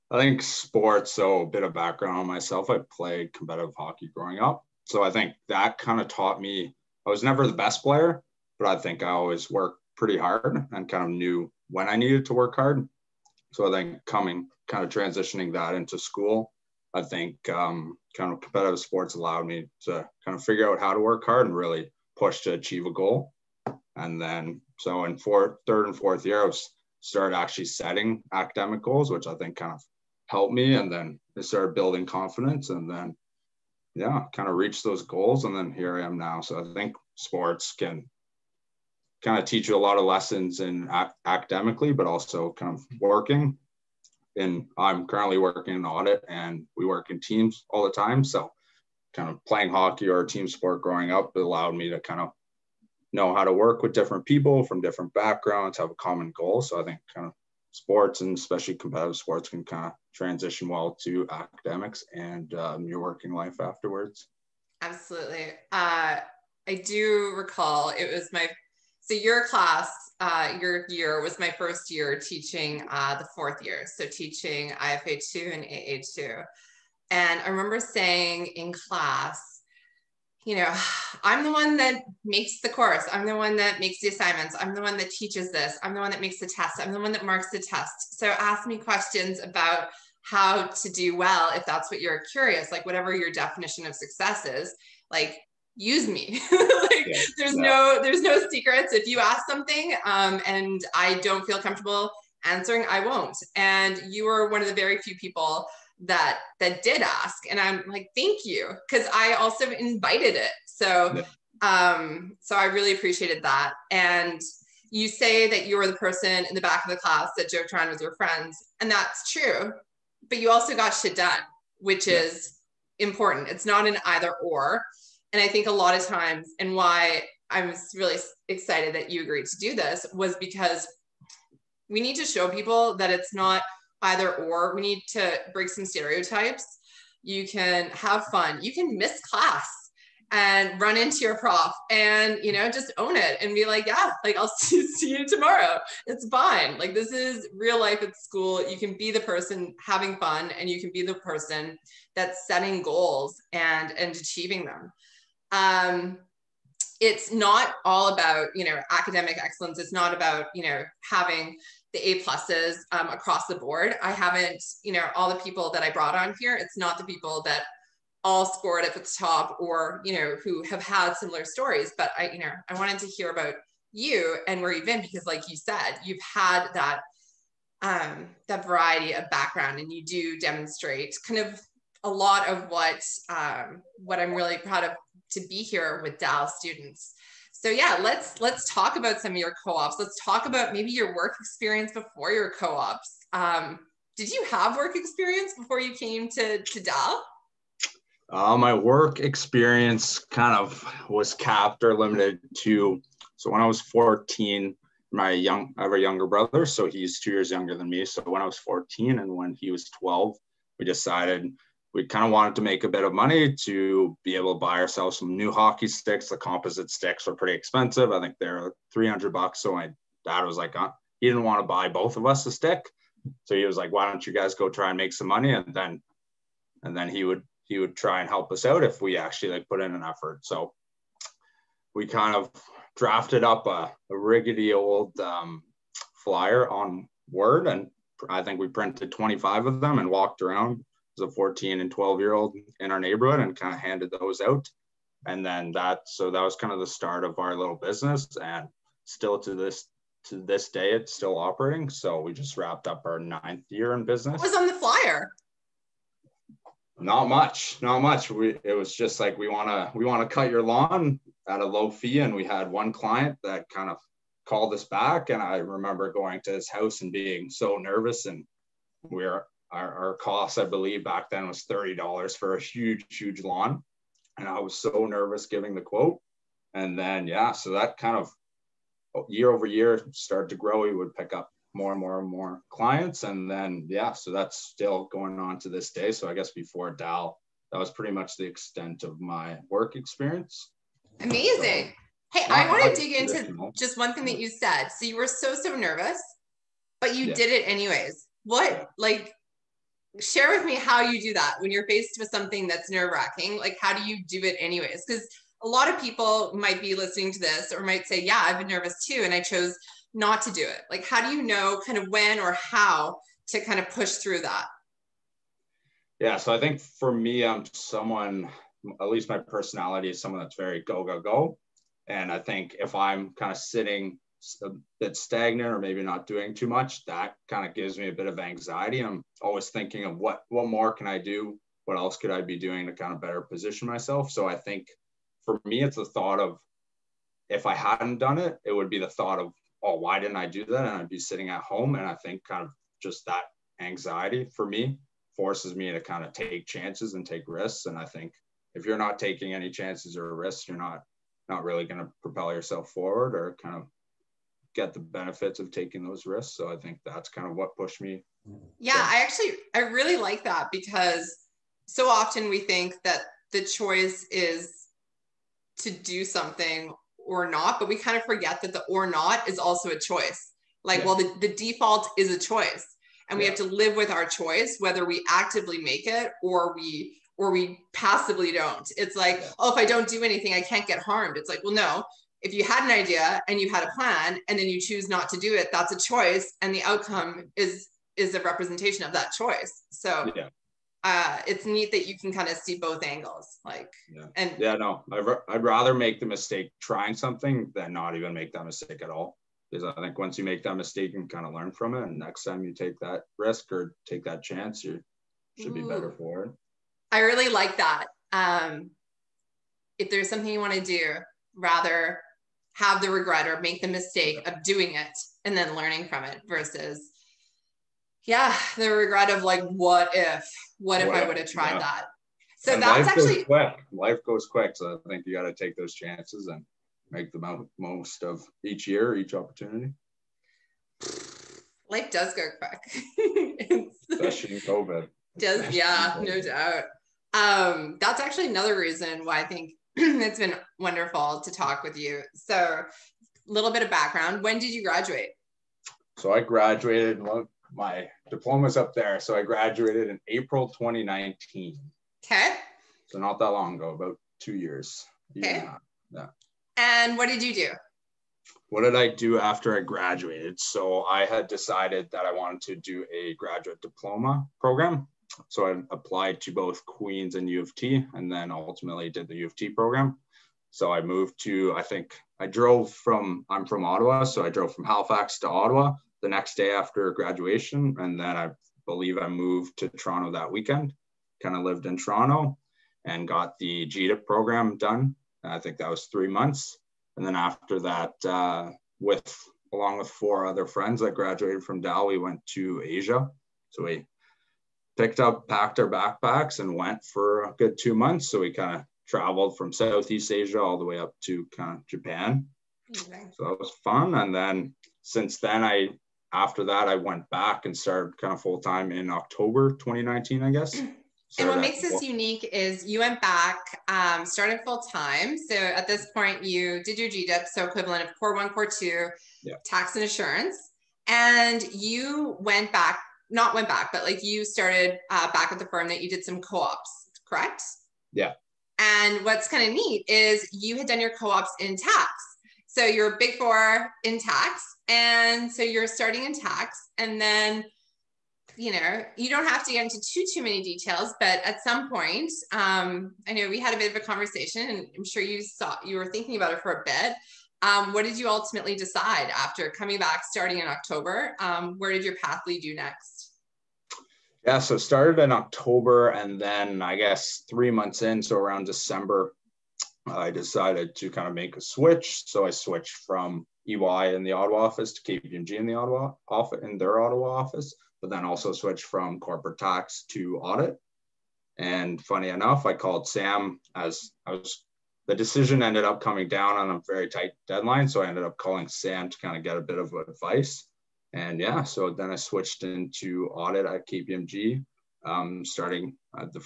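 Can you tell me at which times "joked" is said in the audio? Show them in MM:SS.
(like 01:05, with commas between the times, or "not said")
01:57.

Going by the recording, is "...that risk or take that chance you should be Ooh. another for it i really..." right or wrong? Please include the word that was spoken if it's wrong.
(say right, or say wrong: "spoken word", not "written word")
wrong: "better", not "another".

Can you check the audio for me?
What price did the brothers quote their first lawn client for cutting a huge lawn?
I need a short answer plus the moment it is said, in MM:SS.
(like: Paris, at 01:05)
$30, at 04:31.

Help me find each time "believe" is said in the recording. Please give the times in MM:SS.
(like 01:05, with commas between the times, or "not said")
04:30, 07:58.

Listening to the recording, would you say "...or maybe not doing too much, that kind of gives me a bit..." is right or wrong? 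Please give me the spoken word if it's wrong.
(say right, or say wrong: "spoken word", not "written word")
right.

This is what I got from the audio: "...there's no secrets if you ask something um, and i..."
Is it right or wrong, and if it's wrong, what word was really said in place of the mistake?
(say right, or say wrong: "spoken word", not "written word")
right.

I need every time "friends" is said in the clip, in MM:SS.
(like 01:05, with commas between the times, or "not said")
01:58, 08:10.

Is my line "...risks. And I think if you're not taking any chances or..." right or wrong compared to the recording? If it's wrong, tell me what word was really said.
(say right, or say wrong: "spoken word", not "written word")
right.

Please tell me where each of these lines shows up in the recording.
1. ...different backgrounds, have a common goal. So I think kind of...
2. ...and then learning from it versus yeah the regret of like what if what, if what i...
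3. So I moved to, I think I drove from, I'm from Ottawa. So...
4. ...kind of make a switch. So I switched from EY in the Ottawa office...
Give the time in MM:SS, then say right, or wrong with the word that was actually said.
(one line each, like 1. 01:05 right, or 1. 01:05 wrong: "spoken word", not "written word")
1. 00:54 right
2. 06:55 right
3. 07:50 right
4. 09:21 right.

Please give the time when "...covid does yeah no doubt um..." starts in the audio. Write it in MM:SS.
07:14.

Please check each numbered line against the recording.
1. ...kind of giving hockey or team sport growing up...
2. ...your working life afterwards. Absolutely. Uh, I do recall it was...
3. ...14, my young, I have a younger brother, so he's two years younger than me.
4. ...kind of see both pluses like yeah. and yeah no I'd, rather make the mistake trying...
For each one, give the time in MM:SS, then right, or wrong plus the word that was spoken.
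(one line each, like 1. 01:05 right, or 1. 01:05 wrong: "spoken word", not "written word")
1. 00:49 wrong: "playing", not "giving"
2. 01:02 right
3. 03:23 right
4. 06:32 wrong: "angles", not "pluses".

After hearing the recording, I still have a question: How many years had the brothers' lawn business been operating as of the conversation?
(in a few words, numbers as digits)
9.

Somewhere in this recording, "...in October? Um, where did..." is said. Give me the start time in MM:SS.
09:10.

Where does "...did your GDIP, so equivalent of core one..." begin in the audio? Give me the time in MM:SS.
08:36.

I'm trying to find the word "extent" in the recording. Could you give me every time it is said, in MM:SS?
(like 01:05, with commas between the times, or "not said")
04:48.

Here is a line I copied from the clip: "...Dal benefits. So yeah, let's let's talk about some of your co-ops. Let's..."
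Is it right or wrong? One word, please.
wrong.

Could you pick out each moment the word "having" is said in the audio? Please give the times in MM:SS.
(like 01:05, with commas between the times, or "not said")
02:29, 02:41.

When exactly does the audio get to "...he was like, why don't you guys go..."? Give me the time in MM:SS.
03:43.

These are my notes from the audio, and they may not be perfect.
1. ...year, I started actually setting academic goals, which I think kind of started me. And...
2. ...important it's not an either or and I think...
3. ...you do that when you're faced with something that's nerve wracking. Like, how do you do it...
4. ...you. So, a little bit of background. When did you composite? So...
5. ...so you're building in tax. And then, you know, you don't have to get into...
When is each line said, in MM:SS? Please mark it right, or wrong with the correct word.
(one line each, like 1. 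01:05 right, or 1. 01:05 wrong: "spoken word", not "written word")
1. 00:26 wrong: "helped", not "started"
2. 02:02 right
3. 05:01 right
4. 07:21 wrong: "graduate", not "composite"
5. 08:55 wrong: "starting", not "building".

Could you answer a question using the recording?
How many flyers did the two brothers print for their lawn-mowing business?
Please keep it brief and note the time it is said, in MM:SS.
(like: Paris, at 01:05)
25, at 03:59.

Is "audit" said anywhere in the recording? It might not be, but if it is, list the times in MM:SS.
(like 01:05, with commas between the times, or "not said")
00:45, 09:30, 09:43.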